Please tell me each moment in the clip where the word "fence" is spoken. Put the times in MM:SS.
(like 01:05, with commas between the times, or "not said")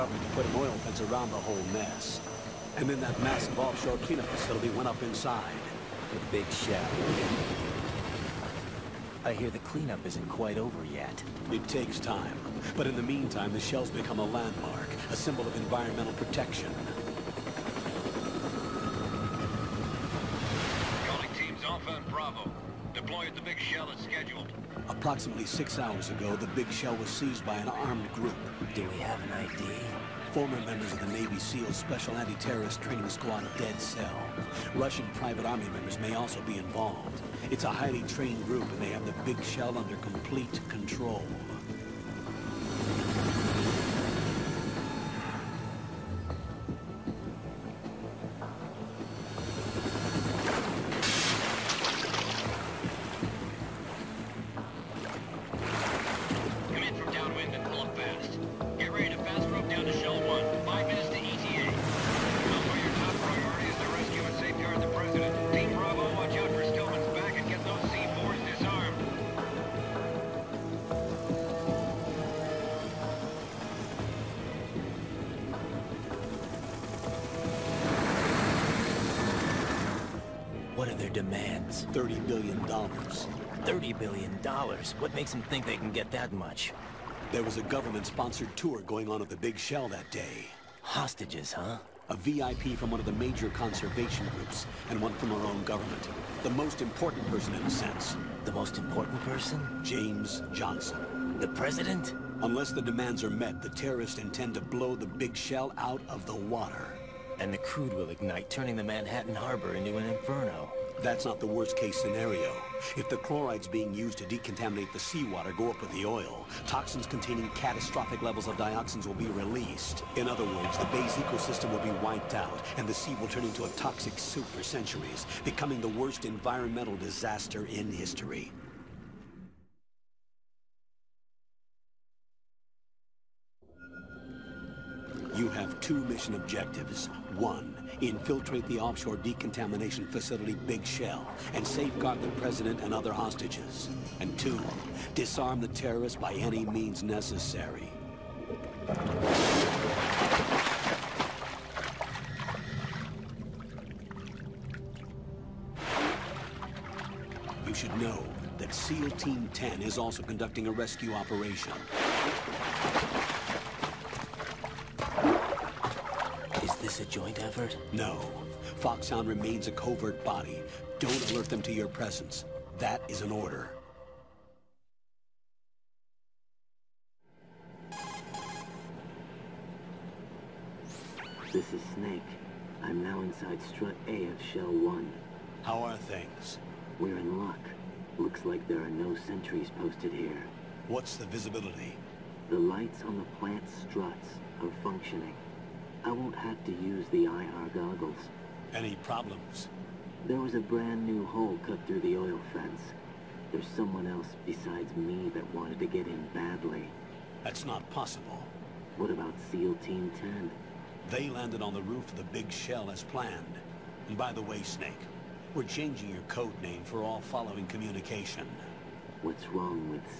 00:00, 03:22.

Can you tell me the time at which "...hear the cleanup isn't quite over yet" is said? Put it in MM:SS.
00:09.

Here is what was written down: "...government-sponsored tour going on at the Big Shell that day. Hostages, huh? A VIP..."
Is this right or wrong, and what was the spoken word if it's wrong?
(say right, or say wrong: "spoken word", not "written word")
right.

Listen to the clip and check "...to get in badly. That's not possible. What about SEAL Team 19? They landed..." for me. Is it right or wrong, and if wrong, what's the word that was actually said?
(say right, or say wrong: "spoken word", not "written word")
wrong: "10", not "19".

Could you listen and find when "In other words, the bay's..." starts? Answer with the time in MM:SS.
02:00.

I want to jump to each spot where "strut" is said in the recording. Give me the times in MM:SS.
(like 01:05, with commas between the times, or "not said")
03:03, 03:13.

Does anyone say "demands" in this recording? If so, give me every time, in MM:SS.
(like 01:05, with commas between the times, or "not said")
01:21, 01:42.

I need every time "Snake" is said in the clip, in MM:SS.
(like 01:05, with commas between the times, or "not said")
03:01, 03:34.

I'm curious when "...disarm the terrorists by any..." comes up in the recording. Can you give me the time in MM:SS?
02:25.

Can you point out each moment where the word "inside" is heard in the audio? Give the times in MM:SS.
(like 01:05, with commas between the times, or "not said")
00:05, 03:03.